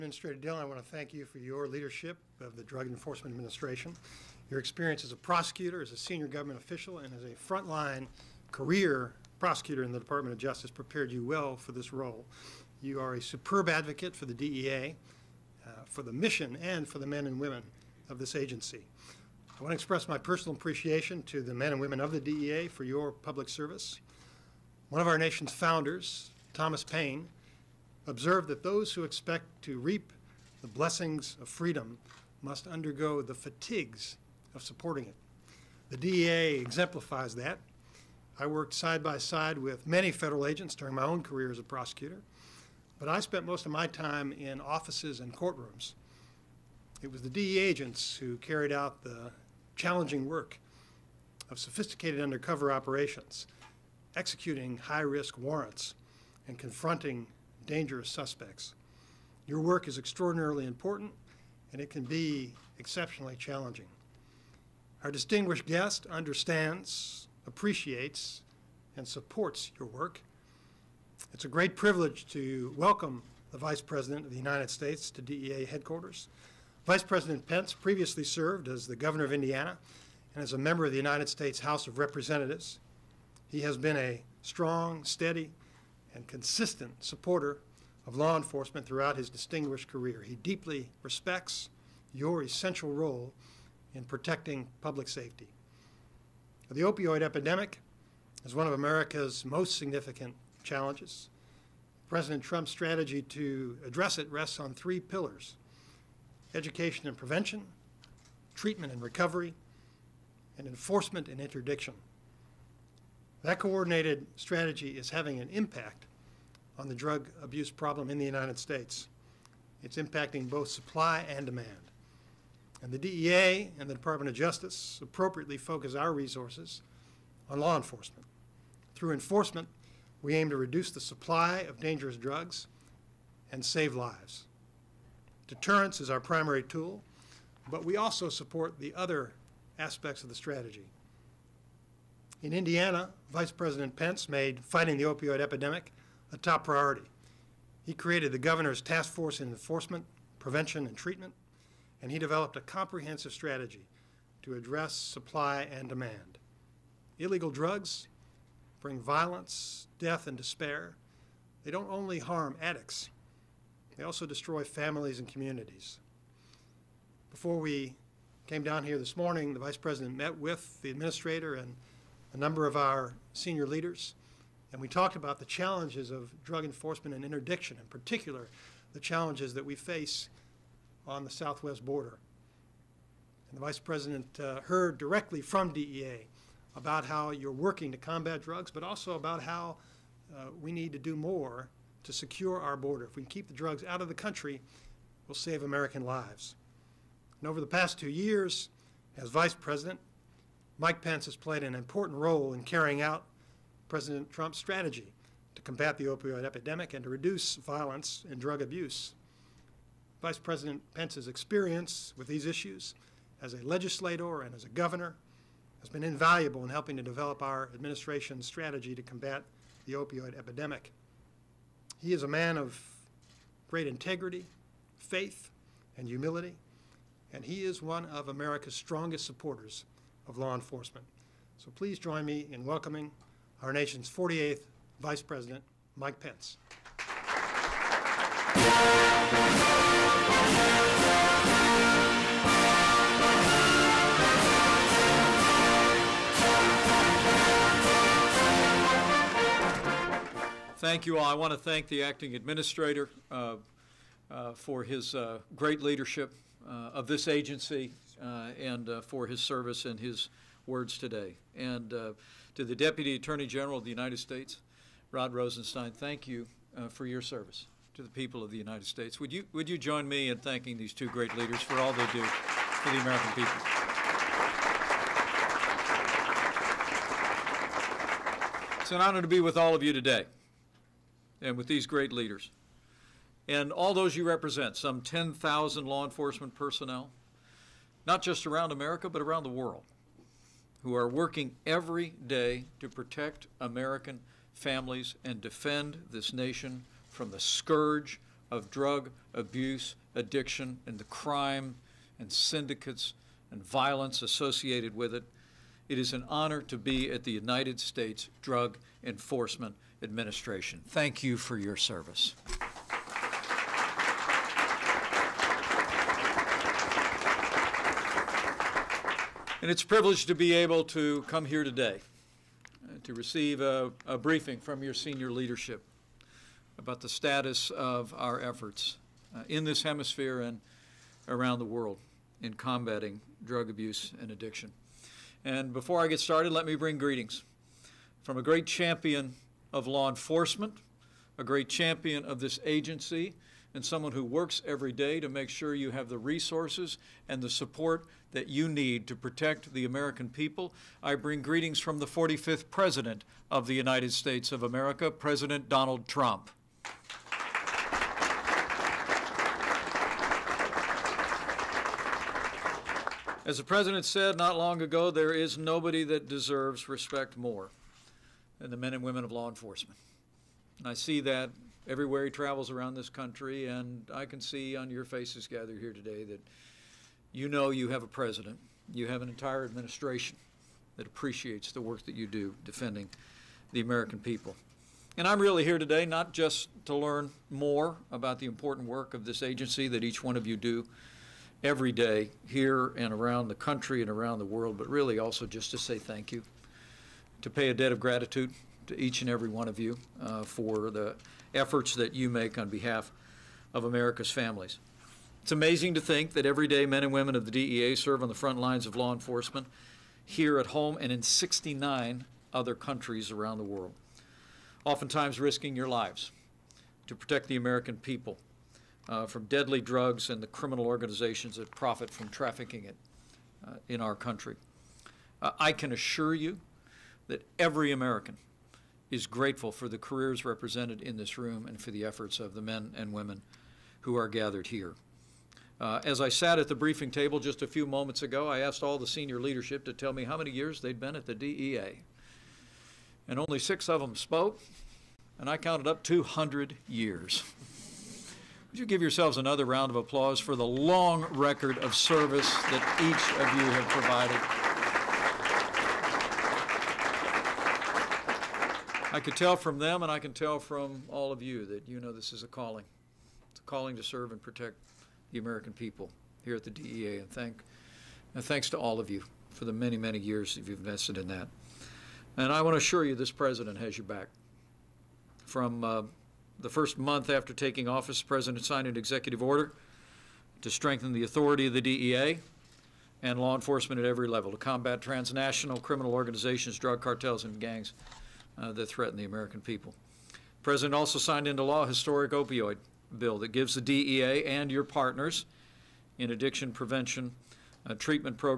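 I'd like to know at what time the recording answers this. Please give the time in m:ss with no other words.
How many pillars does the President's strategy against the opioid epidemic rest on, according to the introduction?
1:44.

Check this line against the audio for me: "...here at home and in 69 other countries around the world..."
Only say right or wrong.
right.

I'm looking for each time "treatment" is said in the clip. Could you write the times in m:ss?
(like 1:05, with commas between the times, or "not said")
1:48, 2:30, 8:17.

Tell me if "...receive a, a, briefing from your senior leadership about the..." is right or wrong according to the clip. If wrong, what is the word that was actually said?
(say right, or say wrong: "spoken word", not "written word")
right.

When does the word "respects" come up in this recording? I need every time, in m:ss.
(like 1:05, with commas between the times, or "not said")
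1:31, 6:06.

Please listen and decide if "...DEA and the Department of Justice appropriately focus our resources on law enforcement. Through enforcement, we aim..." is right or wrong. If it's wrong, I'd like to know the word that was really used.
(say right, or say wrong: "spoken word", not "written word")
right.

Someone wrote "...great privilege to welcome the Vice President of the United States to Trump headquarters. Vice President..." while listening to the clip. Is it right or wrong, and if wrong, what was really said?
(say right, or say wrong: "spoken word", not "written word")
wrong: "DEA", not "Trump".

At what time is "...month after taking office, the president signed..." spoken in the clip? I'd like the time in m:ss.
7:56.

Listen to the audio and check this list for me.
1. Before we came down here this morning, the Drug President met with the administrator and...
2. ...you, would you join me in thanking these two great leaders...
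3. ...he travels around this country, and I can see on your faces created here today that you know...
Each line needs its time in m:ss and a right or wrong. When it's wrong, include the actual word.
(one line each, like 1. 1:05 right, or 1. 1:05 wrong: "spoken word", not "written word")
1. 2:47 wrong: "Vice", not "Drug"
2. 4:29 right
3. 6:12 wrong: "gathered", not "created".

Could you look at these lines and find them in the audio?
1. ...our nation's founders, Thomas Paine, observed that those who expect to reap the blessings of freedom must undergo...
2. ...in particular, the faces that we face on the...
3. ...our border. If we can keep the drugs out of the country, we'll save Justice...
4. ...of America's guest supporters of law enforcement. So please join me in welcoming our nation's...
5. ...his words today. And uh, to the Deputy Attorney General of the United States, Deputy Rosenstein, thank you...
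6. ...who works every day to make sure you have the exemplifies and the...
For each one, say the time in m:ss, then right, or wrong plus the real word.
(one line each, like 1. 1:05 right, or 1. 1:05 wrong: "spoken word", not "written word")
1. 0:25 right
2. 2:57 wrong: "challenges", not "faces"
3. 3:12 wrong: "American", not "Justice"
4. 3:48 wrong: "strongest", not "guest"
5. 4:19 wrong: "Rod", not "Deputy"
6. 5:44 wrong: "resources", not "exemplifies".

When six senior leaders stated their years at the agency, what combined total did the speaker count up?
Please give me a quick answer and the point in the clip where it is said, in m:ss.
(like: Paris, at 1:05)
200 years, at 7:26.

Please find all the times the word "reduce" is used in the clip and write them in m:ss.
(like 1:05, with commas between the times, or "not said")
2:10, 3:27.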